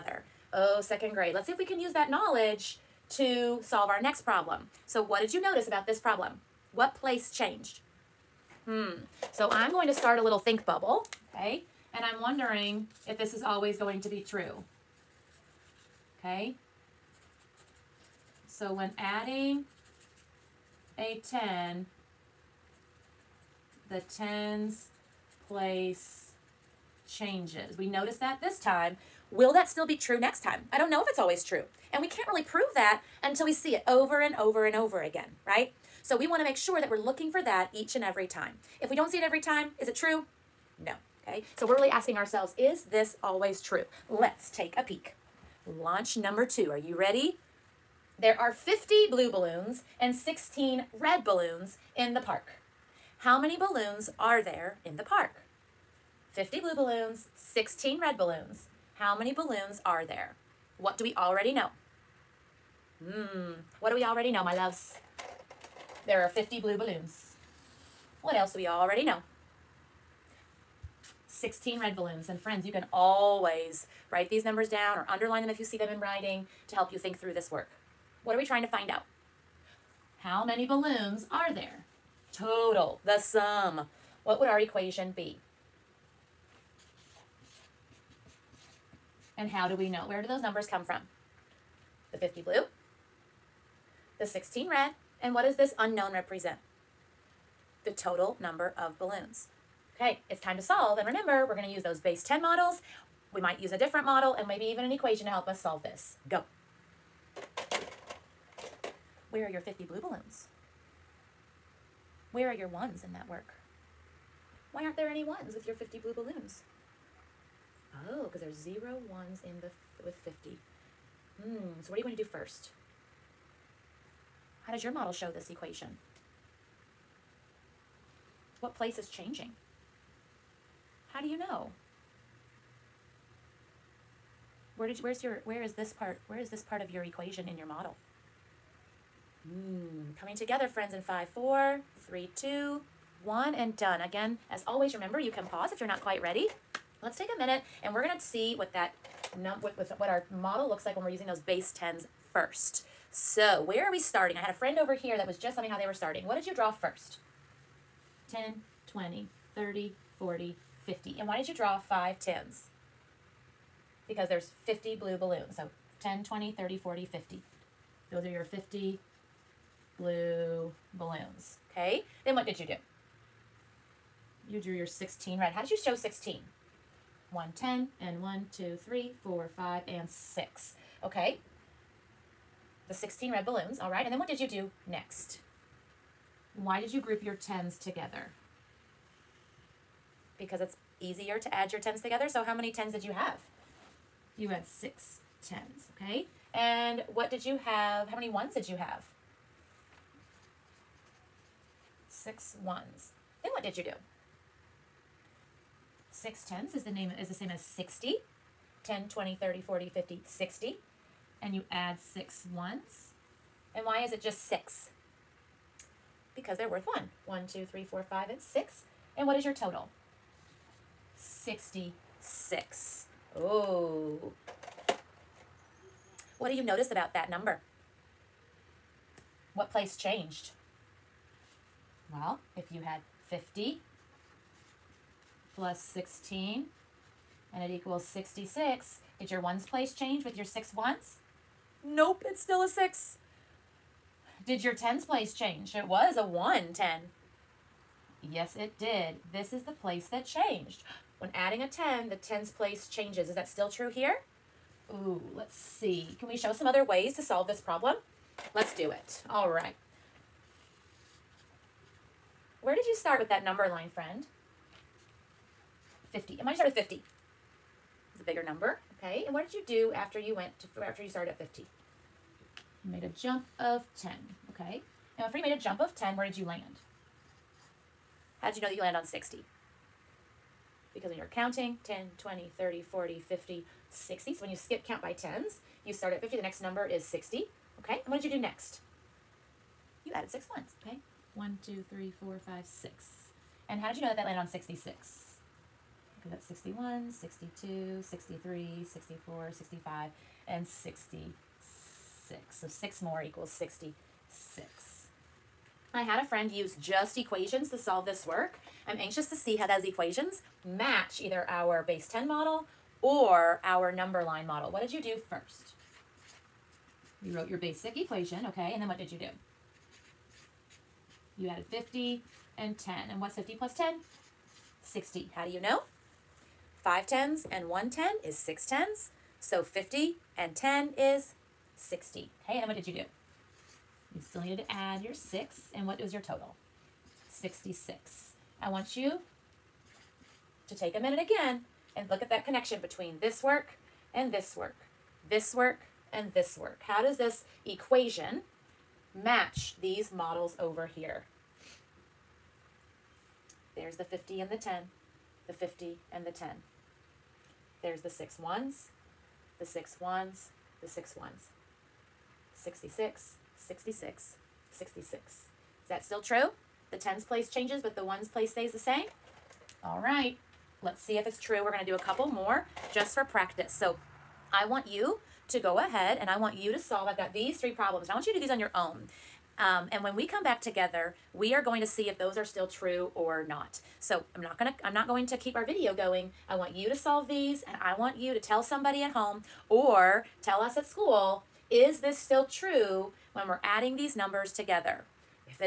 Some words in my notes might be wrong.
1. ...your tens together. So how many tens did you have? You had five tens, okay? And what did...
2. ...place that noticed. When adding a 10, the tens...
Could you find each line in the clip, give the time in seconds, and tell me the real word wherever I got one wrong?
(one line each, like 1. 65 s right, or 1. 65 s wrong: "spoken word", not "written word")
1. 191 s wrong: "six", not "five"
2. 249 s wrong: "changed", not "noticed".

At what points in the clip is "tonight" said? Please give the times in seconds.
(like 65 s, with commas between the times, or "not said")
not said.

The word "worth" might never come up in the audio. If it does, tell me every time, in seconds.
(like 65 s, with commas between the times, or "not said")
216 s.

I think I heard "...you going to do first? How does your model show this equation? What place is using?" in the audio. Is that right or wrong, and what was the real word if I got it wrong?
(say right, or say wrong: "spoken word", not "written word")
wrong: "changing", not "using".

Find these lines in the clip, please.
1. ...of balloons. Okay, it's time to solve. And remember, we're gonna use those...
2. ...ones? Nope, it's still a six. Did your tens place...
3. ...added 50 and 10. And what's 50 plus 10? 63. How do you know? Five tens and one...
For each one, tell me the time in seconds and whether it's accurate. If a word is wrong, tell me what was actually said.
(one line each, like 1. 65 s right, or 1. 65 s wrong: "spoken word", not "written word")
1. 98 s right
2. 240 s right
3. 321 s wrong: "60", not "63".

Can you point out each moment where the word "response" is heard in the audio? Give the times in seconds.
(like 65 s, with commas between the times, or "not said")
not said.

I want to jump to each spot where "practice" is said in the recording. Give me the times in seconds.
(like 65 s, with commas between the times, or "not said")
373 s.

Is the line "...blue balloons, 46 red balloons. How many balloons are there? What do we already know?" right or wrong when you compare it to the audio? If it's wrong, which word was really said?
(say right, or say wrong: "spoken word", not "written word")
wrong: "16", not "46".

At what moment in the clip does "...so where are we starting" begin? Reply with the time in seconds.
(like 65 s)
153 s.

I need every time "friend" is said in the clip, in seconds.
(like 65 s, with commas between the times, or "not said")
72 s, 140 s, 154 s, 263 s, 306 s.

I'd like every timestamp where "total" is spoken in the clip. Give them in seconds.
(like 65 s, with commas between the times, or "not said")
82 s, 97 s, 219 s, 336 s.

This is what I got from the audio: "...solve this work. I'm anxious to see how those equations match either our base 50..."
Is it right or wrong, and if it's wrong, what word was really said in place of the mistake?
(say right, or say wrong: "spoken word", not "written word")
wrong: "10", not "50".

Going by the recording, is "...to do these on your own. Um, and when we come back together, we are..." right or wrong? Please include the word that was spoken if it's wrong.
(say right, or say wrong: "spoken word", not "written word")
right.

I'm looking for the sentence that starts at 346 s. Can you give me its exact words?
How does this equation match these models over here?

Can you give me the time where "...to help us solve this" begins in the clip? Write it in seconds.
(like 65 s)
105 s.